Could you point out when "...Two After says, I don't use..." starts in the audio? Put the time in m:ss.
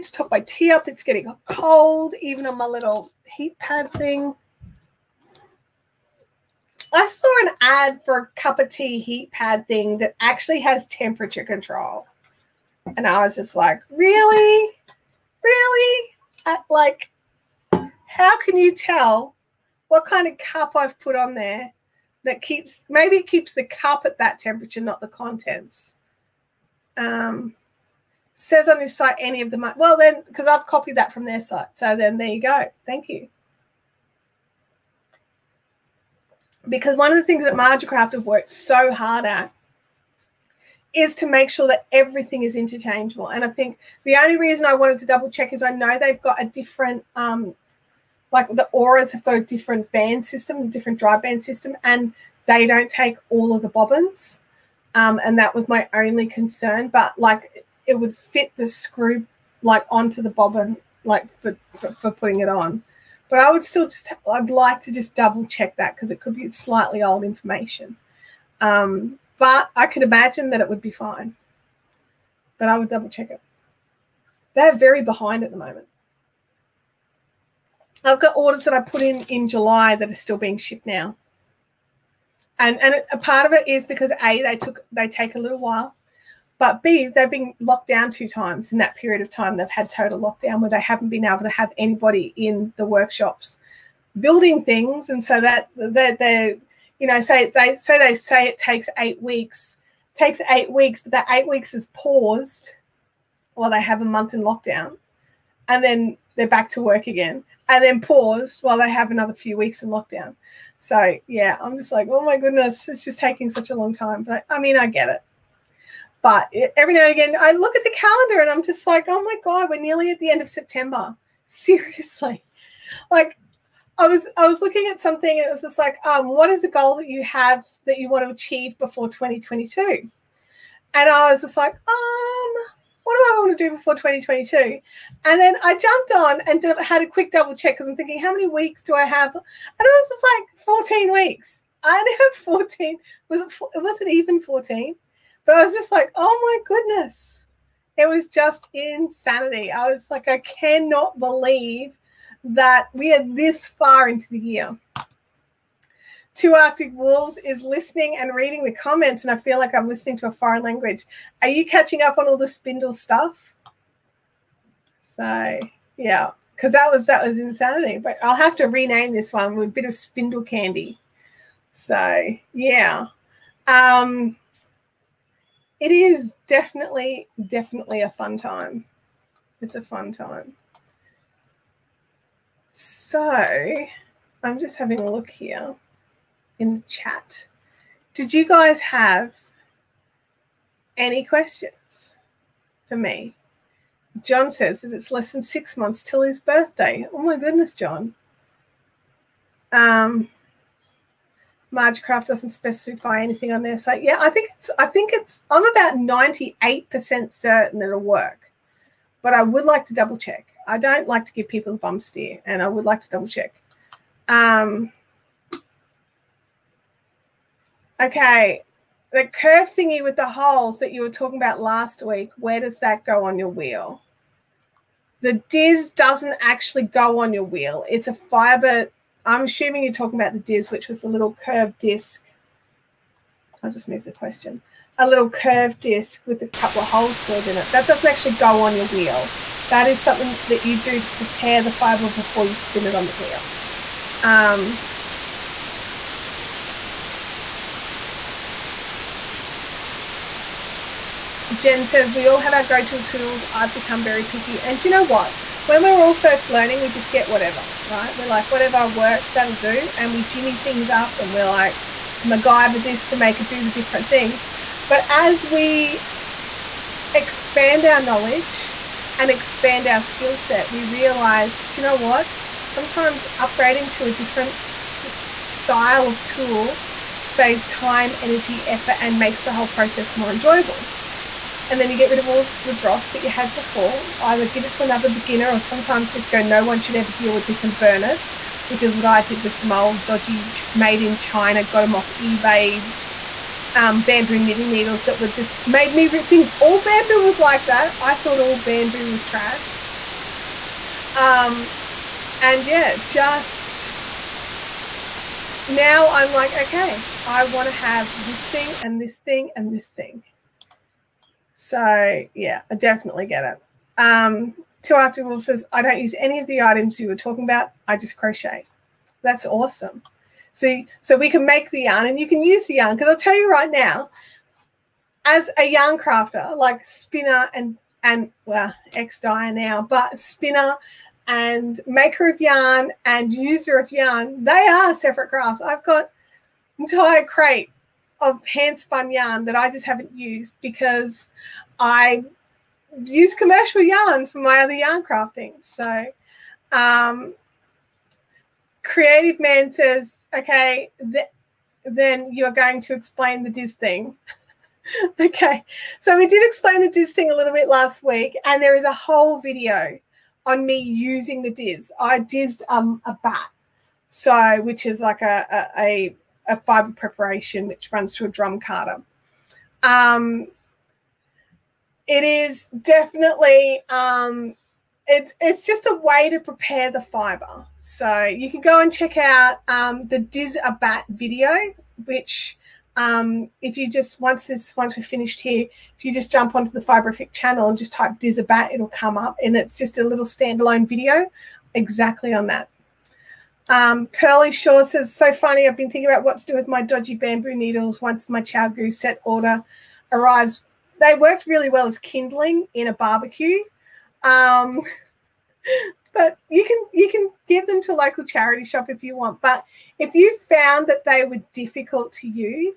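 5:14.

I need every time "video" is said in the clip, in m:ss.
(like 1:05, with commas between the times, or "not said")
5:59, 6:21, 6:30.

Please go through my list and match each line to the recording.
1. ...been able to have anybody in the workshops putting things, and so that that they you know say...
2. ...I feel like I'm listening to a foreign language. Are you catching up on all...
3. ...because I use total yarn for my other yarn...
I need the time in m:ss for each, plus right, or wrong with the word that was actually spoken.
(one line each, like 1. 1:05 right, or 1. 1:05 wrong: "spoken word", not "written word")
1. 1:31 wrong: "building", not "putting"
2. 2:39 right
3. 5:40 wrong: "commercial", not "total".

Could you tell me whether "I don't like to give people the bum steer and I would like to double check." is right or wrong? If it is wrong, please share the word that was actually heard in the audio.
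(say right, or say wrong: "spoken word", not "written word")
right.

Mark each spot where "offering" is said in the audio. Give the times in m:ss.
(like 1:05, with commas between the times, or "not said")
not said.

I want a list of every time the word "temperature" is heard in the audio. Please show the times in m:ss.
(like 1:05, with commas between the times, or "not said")
0:10, 0:24.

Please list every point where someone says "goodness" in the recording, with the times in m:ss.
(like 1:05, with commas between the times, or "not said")
1:52, 2:26, 3:17.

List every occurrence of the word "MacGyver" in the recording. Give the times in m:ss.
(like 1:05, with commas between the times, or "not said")
4:22.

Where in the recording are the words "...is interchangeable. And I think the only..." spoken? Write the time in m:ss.
0:42.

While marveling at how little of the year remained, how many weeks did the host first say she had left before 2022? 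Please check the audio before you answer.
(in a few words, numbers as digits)
14.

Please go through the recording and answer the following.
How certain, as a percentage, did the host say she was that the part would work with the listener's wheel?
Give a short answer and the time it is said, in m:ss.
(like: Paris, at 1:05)
98%, at 3:25.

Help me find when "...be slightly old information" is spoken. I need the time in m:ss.
1:06.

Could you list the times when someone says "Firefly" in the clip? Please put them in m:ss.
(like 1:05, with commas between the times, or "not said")
not said.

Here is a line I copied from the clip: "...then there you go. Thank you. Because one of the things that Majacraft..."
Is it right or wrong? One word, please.
right.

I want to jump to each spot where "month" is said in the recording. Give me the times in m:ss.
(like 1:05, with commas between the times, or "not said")
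1:44, 3:15.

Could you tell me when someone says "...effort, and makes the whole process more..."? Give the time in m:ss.
4:38.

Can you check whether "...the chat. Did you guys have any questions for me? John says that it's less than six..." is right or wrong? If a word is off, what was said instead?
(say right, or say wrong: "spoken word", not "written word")
right.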